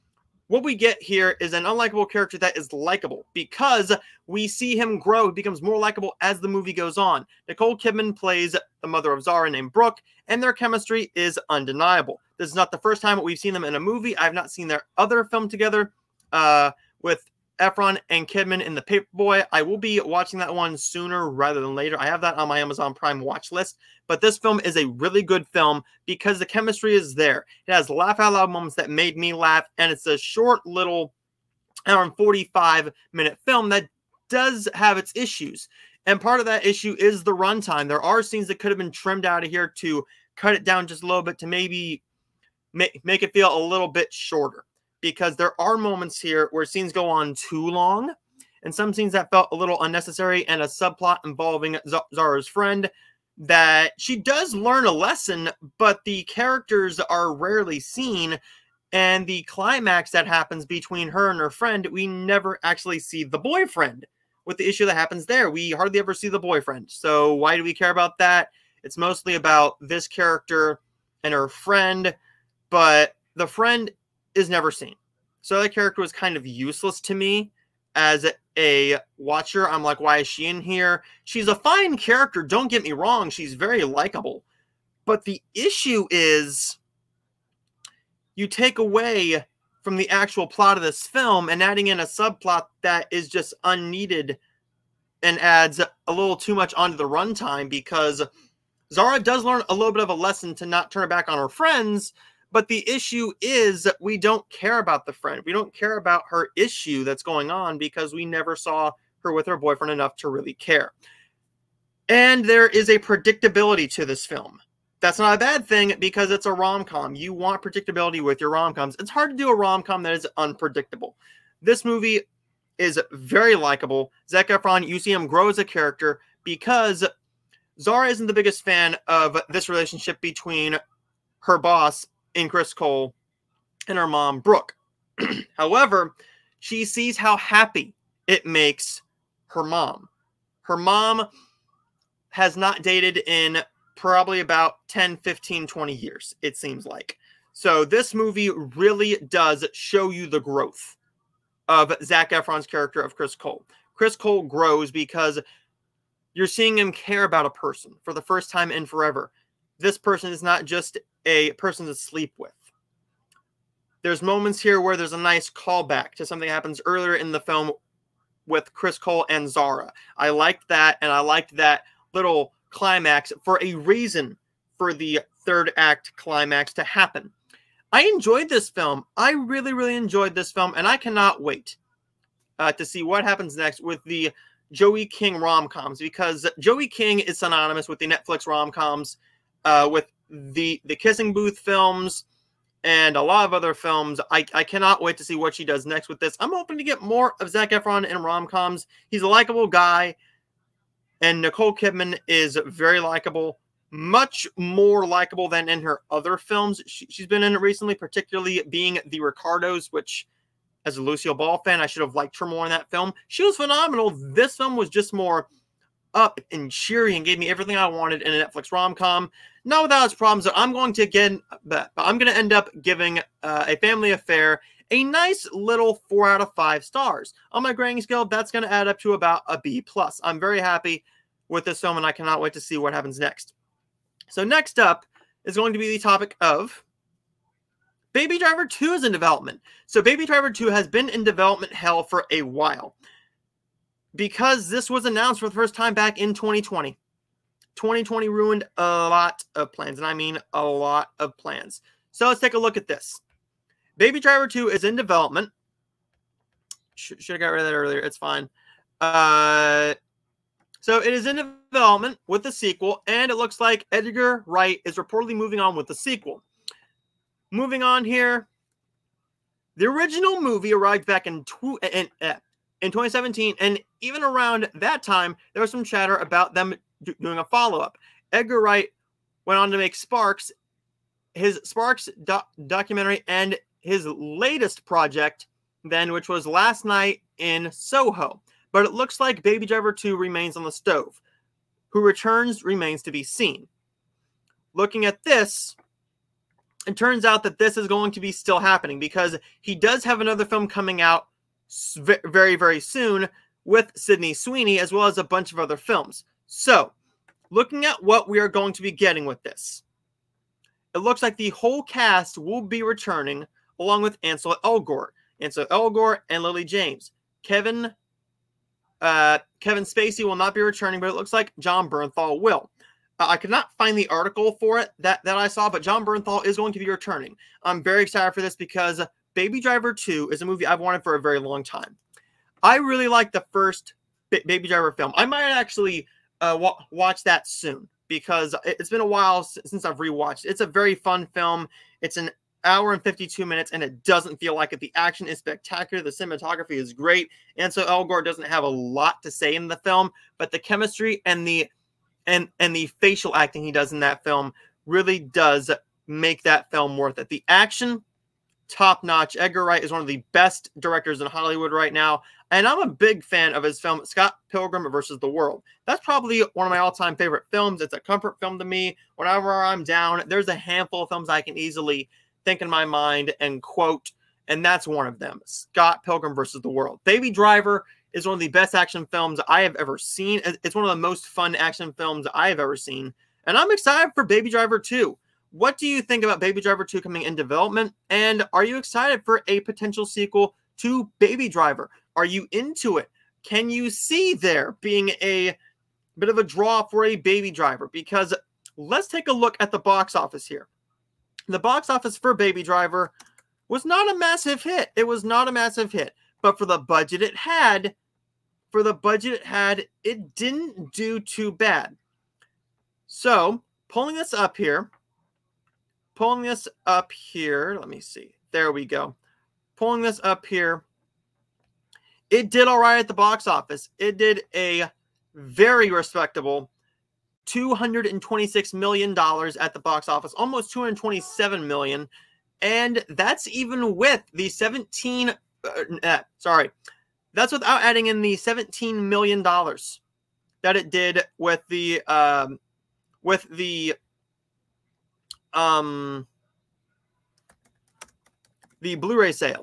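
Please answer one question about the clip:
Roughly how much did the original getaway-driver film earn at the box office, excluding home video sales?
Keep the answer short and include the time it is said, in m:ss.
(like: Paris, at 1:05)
$226 million, at 7:07.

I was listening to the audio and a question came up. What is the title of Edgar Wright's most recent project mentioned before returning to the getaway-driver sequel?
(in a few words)
Last Night in Soho.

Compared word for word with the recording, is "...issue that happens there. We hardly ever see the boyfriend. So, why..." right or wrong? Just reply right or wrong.
right.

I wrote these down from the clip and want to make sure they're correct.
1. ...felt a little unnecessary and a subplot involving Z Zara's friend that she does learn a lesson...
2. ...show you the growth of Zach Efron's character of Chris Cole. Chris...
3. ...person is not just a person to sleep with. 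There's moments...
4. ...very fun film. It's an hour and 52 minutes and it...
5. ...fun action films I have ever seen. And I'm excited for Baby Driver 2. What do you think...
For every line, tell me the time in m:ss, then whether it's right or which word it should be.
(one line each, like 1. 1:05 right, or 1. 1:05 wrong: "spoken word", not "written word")
1. 0:49 right
2. 2:29 right
3. 2:39 right
4. 5:40 right
5. 6:21 right.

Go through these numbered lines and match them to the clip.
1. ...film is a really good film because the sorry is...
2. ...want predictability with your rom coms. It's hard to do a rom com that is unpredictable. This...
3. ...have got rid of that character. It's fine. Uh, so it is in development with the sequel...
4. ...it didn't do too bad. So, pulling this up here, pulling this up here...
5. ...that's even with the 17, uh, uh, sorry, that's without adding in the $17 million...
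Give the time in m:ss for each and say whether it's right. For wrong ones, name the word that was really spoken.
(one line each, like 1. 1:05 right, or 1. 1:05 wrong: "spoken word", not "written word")
1. 0:24 wrong: "chemistry", not "sorry"
2. 1:57 right
3. 4:17 wrong: "earlier", not "character"
4. 6:50 right
5. 7:13 right.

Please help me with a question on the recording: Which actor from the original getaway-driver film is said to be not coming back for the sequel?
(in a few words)
Kevin Spacey.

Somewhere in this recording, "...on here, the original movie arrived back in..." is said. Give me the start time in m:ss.
4:27.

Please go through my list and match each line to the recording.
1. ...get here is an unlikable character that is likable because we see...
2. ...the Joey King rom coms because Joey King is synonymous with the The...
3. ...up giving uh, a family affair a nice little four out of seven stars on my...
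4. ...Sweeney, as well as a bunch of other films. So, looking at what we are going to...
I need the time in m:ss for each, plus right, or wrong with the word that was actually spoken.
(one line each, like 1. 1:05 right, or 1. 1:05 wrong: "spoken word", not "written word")
1. 0:00 right
2. 3:04 wrong: "Netflix", not "The"
3. 3:42 wrong: "five", not "seven"
4. 5:04 right.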